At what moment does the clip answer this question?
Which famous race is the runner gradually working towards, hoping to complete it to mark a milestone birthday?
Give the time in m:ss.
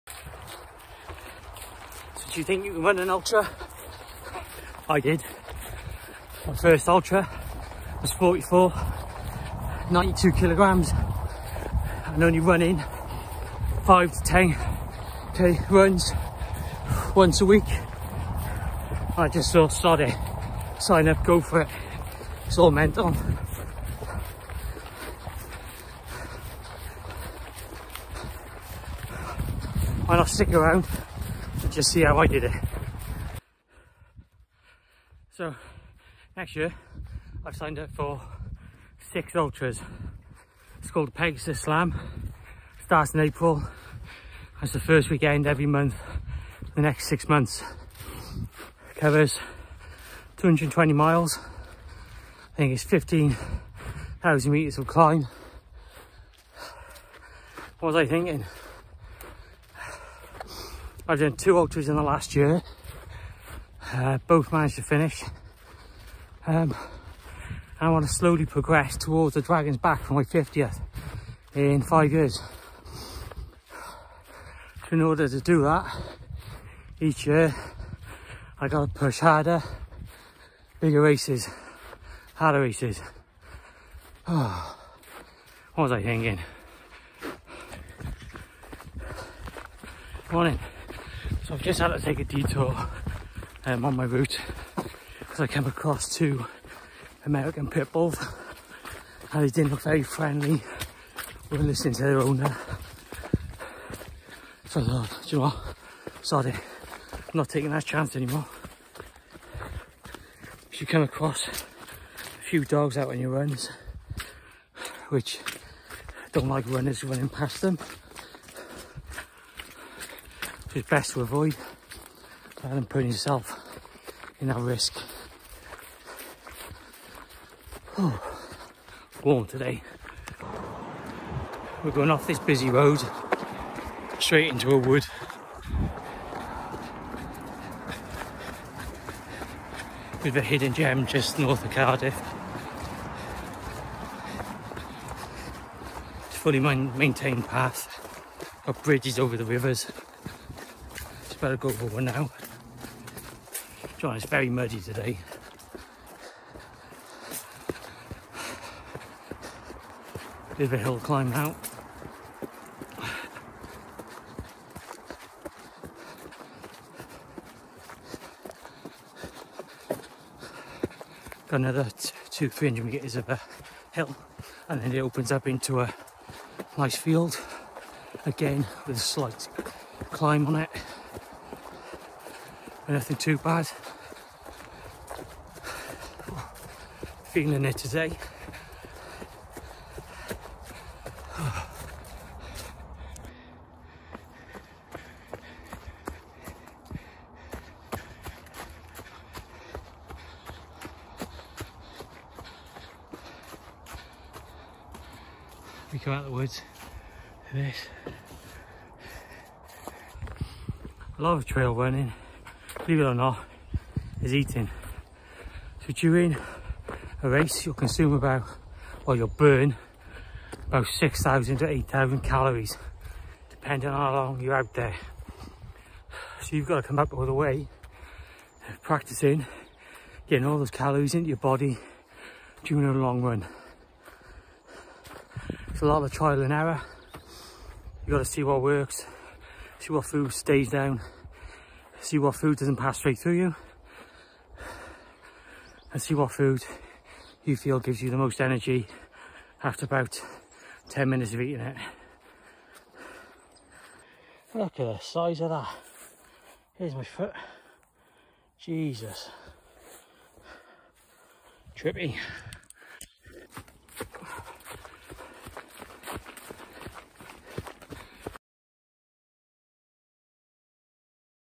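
1:09.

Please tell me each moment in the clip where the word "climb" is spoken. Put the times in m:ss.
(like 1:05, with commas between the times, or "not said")
0:54, 2:40, 3:00.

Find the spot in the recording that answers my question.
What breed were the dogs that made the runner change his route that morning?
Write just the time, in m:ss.
1:37.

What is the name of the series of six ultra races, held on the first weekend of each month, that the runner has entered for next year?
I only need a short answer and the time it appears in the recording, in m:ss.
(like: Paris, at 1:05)
Pegasus Slam, at 0:41.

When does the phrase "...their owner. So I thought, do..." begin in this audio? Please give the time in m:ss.
1:42.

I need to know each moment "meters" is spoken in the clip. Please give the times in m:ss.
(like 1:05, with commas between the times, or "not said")
0:54, 2:52.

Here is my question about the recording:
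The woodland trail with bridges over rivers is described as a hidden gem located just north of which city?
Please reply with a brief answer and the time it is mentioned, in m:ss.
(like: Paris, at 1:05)
Cardiff, at 2:21.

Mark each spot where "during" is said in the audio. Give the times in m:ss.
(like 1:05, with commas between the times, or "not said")
3:35, 3:52.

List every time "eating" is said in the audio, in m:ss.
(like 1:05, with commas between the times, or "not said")
3:34, 4:11.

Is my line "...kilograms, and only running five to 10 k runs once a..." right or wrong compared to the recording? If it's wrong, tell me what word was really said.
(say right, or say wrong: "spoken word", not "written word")
right.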